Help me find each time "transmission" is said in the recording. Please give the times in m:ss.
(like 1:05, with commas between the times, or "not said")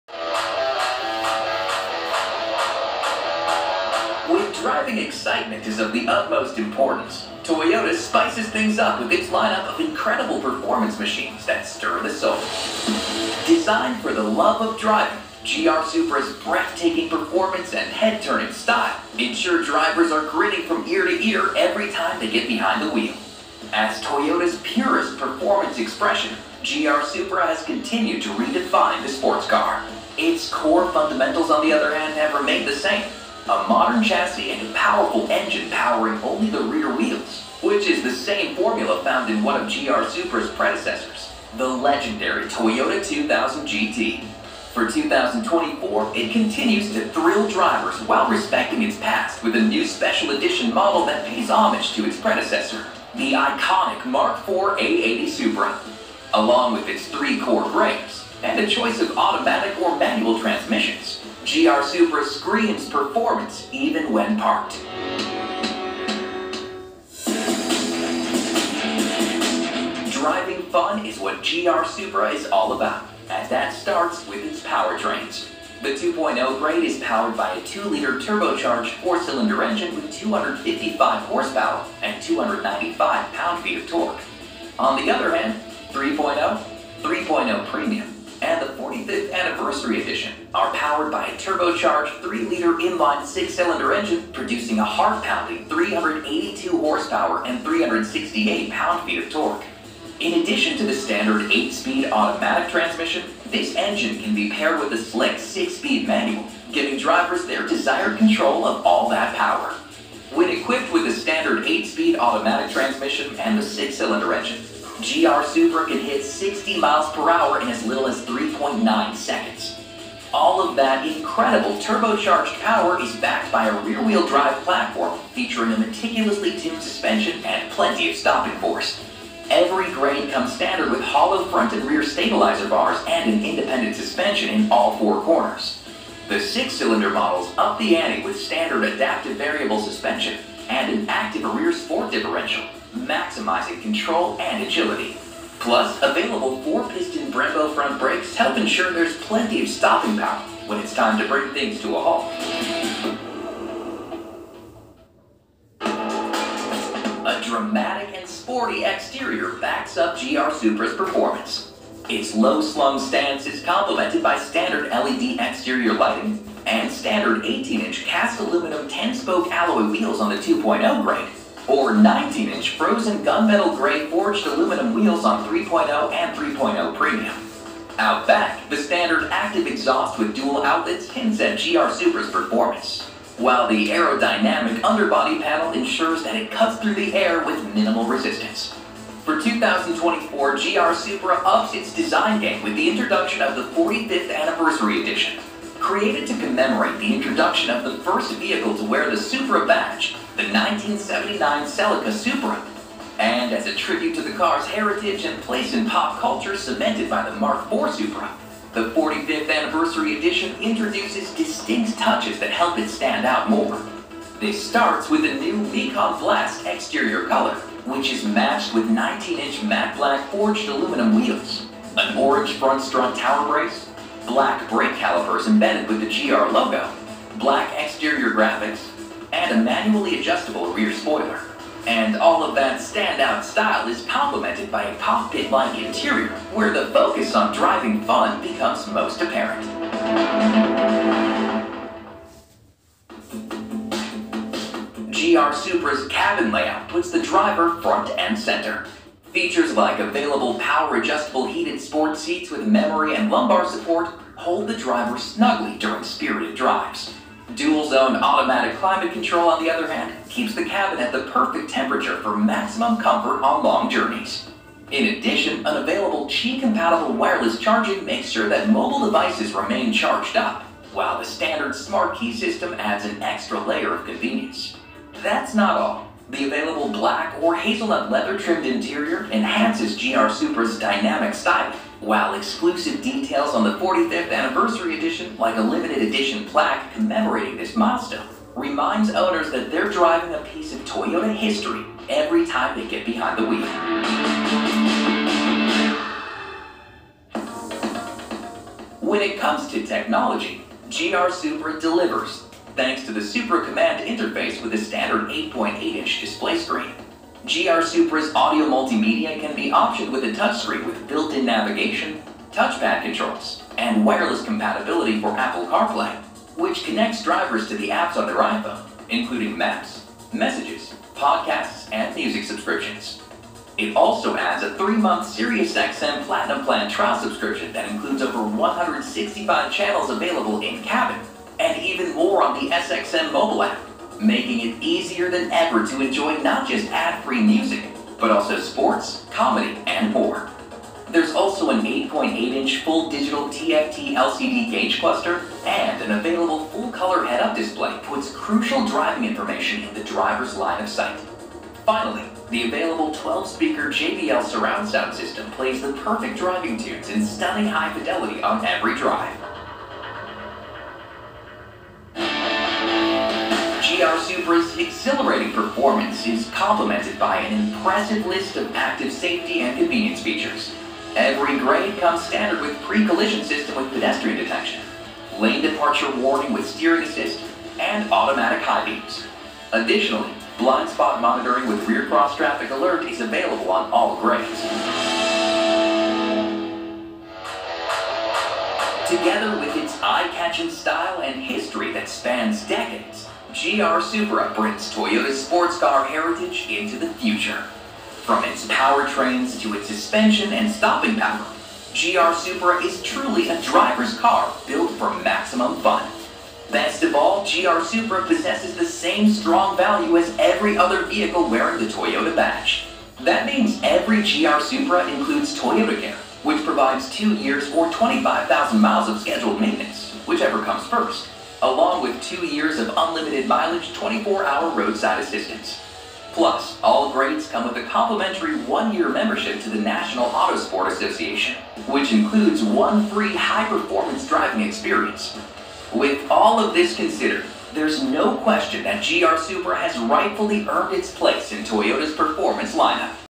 1:00, 1:42, 1:52.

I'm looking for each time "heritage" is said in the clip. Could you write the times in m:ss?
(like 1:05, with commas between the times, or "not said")
3:24, 6:36.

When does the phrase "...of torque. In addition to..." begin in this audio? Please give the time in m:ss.
1:39.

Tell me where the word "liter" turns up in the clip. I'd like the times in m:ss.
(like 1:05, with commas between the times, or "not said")
1:17, 1:32.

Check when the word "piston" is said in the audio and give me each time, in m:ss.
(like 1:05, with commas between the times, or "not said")
2:26.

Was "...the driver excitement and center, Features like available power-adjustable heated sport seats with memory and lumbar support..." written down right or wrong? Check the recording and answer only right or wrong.
wrong.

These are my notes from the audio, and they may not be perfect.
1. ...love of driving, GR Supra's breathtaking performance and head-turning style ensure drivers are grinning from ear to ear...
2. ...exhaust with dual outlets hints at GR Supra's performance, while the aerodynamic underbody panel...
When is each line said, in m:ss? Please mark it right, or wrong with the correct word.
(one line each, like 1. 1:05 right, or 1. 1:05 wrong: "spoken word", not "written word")
1. 0:14 right
2. 2:59 right.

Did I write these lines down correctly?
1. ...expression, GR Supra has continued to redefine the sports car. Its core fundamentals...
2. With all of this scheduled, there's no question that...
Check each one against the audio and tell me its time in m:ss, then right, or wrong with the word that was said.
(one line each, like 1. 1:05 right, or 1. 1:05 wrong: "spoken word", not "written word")
1. 0:25 right
2. 7:15 wrong: "considered", not "scheduled".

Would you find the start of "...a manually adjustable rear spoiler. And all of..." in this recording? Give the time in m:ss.
3:49.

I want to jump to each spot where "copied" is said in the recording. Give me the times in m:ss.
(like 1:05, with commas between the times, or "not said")
not said.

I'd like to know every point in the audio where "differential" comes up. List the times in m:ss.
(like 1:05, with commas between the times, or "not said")
2:22.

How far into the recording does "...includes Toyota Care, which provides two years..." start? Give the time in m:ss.
6:55.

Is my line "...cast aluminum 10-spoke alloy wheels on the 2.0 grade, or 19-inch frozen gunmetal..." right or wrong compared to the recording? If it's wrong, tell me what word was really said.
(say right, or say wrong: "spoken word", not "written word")
right.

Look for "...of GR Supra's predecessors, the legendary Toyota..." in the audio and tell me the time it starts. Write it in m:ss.
0:39.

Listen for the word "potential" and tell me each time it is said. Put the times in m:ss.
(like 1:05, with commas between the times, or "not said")
not said.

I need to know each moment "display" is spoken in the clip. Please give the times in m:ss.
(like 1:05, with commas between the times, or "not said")
5:06, 5:47.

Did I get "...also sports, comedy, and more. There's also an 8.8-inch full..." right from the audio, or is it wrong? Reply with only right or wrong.
right.